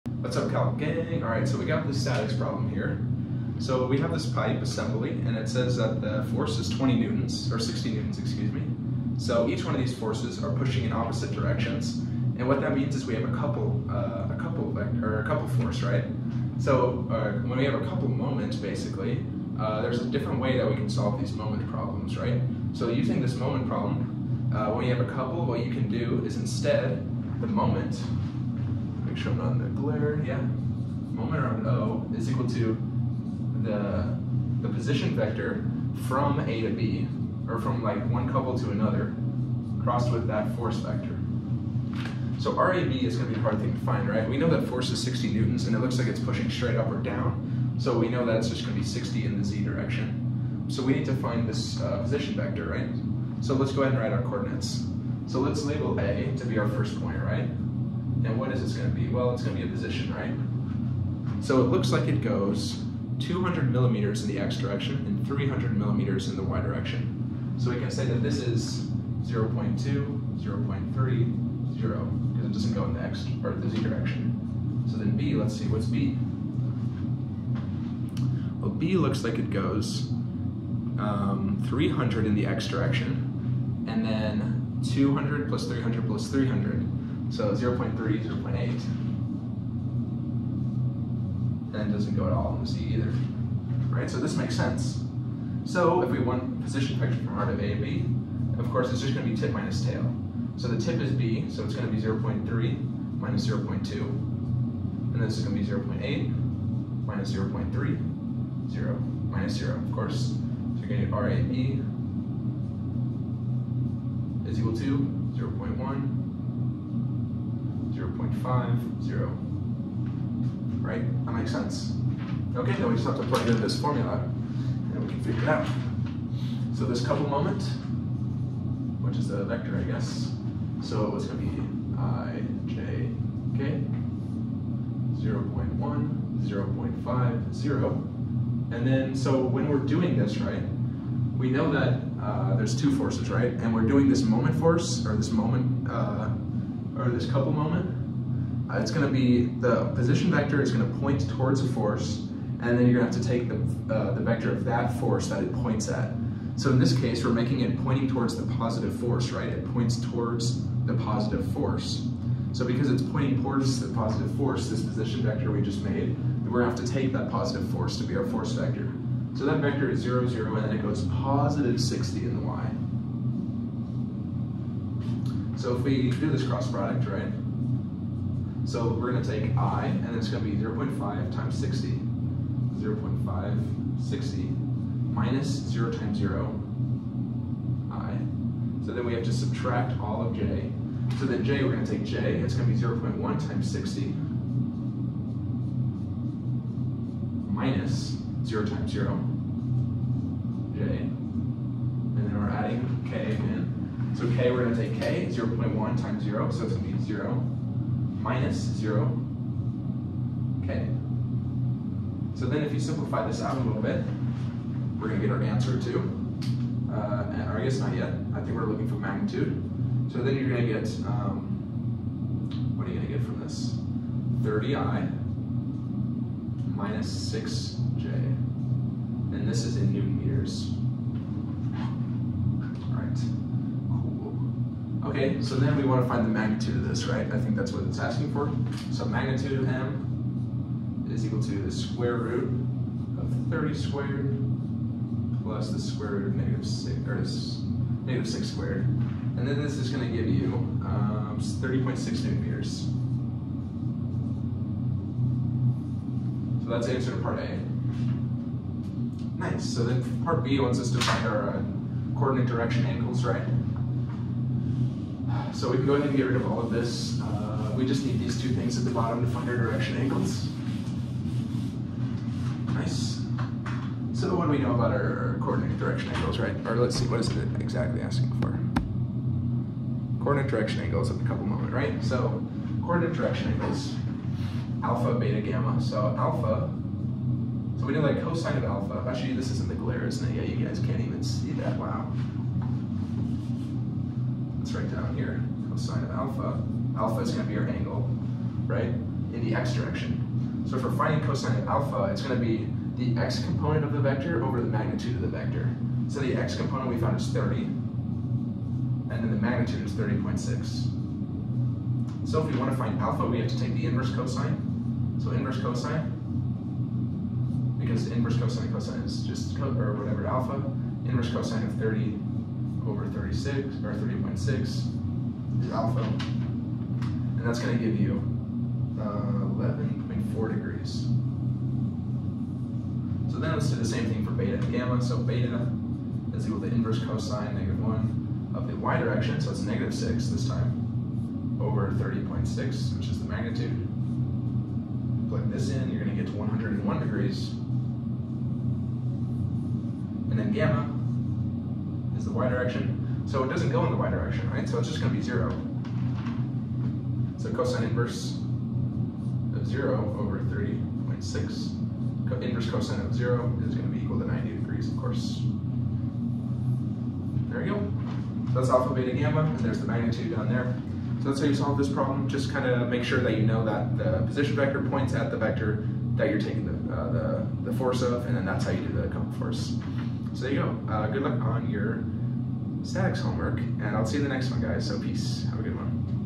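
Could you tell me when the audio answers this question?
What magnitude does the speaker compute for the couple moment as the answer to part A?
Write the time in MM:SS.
04:11.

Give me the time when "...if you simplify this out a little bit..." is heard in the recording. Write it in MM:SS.
03:32.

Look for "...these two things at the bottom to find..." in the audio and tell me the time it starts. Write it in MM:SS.
04:28.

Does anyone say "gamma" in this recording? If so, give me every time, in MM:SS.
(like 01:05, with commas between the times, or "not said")
04:45, 05:34, 05:50, 06:09.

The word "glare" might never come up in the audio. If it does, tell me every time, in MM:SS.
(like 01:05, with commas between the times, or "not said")
00:29, 04:49.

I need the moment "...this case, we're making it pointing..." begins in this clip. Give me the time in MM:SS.
02:36.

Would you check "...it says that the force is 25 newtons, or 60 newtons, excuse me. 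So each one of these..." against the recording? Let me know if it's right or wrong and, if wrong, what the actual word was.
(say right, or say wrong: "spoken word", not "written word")
wrong: "20", not "25".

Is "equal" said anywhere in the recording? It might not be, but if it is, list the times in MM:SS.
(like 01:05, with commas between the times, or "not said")
00:32, 01:54, 04:01, 05:36, 06:04.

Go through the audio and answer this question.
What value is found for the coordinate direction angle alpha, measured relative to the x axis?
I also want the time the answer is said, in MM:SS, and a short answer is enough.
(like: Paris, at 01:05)
11.4 degrees, at 05:29.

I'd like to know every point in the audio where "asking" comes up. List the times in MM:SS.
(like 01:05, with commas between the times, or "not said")
03:57, 04:38.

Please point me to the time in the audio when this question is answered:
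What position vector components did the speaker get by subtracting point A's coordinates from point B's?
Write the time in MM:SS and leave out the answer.
01:55.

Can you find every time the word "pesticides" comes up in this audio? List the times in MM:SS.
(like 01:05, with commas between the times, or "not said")
not said.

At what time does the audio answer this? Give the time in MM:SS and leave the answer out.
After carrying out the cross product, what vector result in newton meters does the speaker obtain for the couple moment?
03:44.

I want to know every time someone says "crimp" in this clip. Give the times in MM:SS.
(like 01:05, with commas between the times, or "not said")
not said.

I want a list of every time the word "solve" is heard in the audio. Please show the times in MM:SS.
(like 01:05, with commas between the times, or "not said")
00:20, 06:11.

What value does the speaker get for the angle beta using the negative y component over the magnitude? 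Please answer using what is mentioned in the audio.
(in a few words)
101 degrees.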